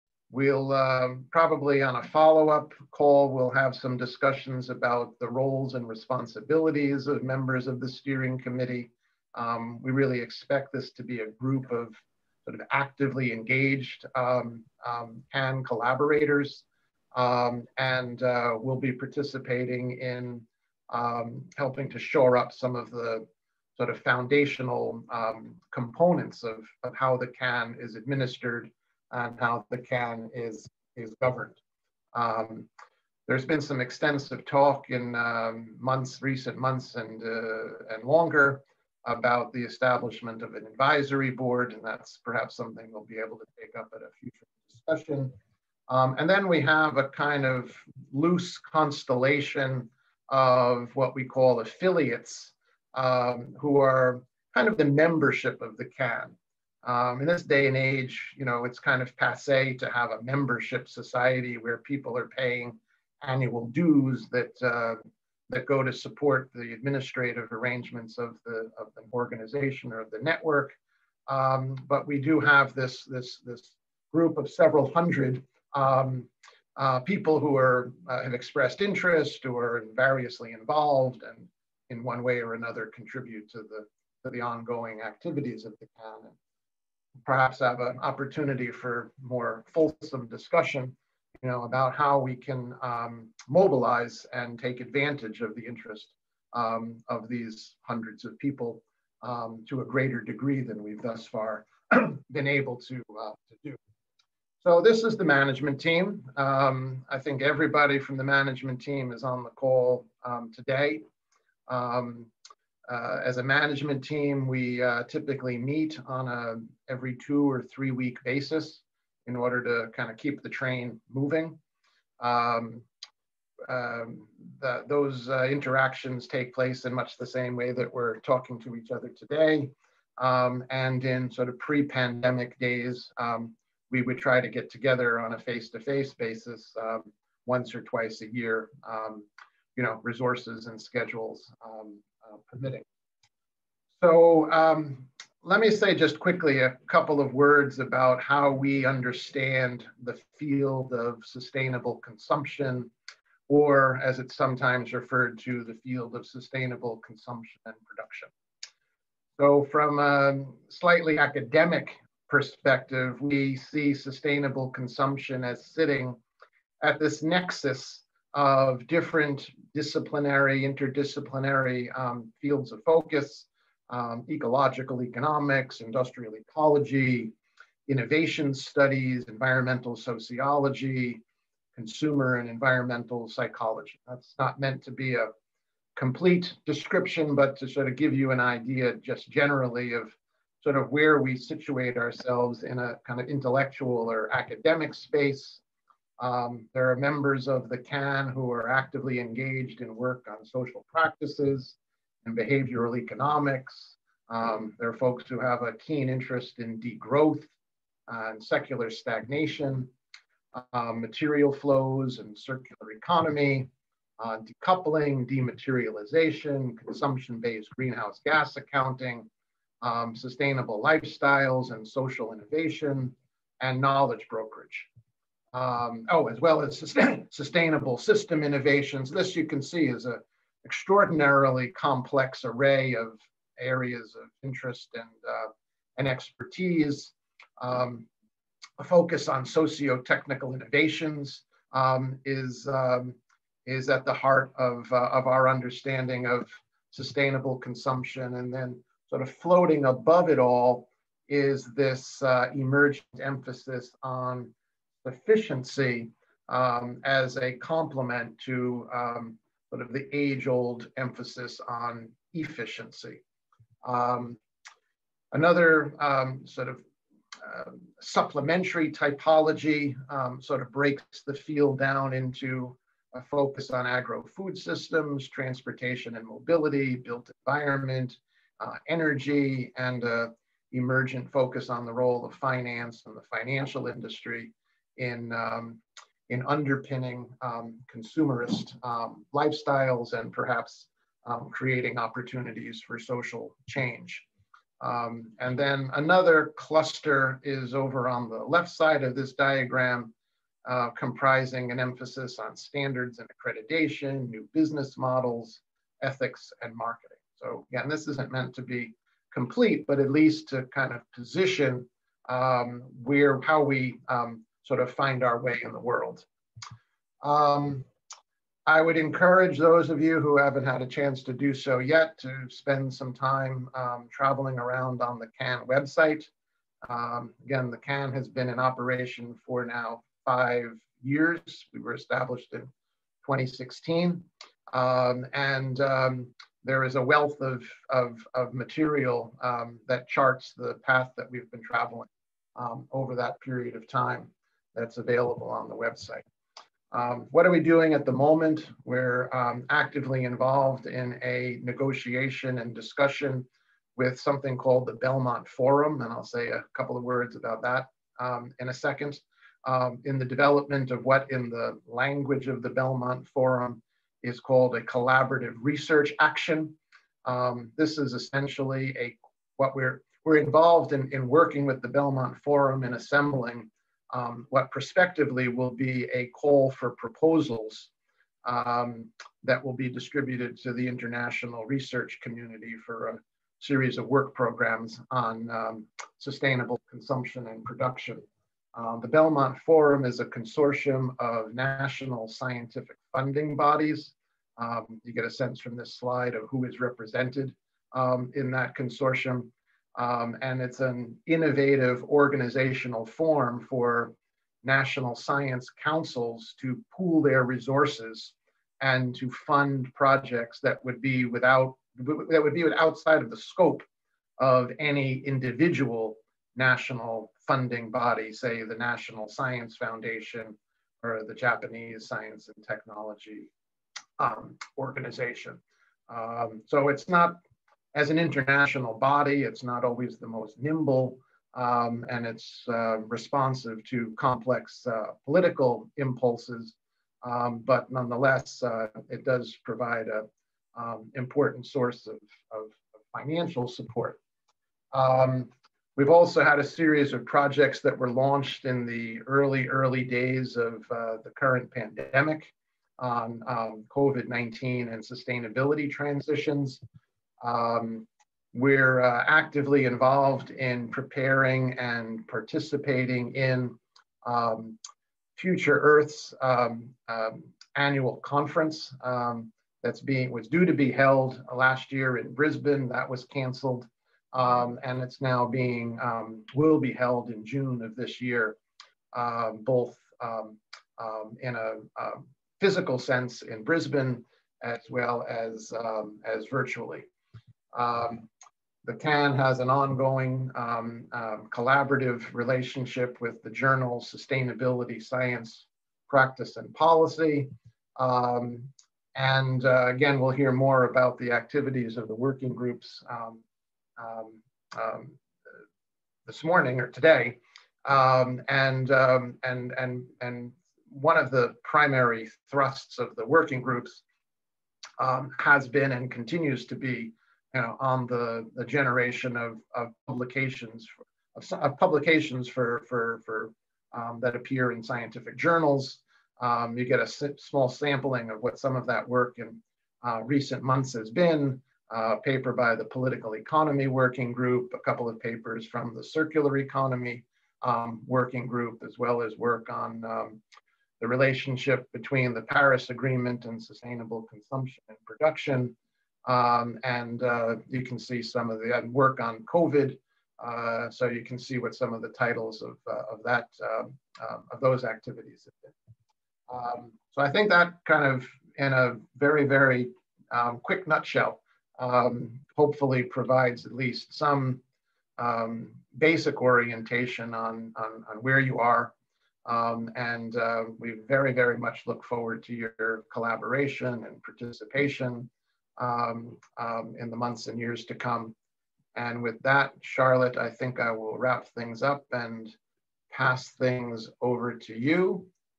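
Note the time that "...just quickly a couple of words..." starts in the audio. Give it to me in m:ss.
2:25.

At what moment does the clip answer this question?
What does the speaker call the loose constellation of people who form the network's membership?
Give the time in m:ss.
0:51.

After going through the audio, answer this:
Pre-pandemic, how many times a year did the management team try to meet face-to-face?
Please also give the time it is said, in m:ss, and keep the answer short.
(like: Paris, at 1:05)
once or twice, at 2:17.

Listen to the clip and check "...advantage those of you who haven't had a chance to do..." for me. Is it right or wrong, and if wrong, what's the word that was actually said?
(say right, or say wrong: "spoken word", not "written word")
wrong: "encourage", not "advantage".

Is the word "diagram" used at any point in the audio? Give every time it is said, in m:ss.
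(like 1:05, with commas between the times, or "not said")
4:59.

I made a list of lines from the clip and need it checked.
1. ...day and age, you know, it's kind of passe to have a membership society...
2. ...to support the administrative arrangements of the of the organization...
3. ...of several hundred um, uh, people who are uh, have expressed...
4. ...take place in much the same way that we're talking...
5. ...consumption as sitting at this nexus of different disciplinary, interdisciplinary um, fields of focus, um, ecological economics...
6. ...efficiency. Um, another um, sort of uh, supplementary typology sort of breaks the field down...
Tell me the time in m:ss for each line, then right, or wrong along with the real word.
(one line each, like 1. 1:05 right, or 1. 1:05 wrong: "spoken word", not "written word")
1. 0:57 right
2. 1:05 right
3. 1:14 right
4. 2:06 right
5. 2:44 right
6. 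4:22 right.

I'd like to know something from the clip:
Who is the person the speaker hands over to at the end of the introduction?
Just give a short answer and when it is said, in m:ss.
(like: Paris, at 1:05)
Charlotte, at 9:39.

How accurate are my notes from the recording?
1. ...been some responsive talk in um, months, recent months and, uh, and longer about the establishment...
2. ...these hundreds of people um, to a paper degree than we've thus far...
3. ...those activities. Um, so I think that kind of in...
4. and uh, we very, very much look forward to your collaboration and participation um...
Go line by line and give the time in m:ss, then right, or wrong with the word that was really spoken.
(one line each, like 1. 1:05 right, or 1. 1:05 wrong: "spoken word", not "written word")
1. 0:33 wrong: "extensive", not "responsive"
2. 1:37 wrong: "greater", not "paper"
3. 9:14 right
4. 9:29 right.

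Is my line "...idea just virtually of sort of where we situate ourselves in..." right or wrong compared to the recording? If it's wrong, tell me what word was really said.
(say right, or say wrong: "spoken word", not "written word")
wrong: "generally", not "virtually".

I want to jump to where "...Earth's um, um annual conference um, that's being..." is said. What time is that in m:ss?
7:45.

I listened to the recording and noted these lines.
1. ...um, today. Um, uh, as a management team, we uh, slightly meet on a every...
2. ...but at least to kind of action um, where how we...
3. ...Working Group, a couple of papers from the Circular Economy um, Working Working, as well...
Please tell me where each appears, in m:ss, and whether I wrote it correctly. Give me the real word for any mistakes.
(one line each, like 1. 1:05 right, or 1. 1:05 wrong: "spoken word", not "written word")
1. 1:50 wrong: "typically", not "slightly"
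2. 5:09 wrong: "position", not "action"
3. 8:53 wrong: "Group", not "Working".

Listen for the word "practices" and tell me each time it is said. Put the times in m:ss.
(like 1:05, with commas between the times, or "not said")
3:20, 8:16.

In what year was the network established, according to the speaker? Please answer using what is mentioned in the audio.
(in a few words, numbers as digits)
2016.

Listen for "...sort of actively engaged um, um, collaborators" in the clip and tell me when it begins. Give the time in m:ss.
0:12.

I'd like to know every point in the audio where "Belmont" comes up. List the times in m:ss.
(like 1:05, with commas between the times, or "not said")
5:54, 6:02, 6:11, 6:29.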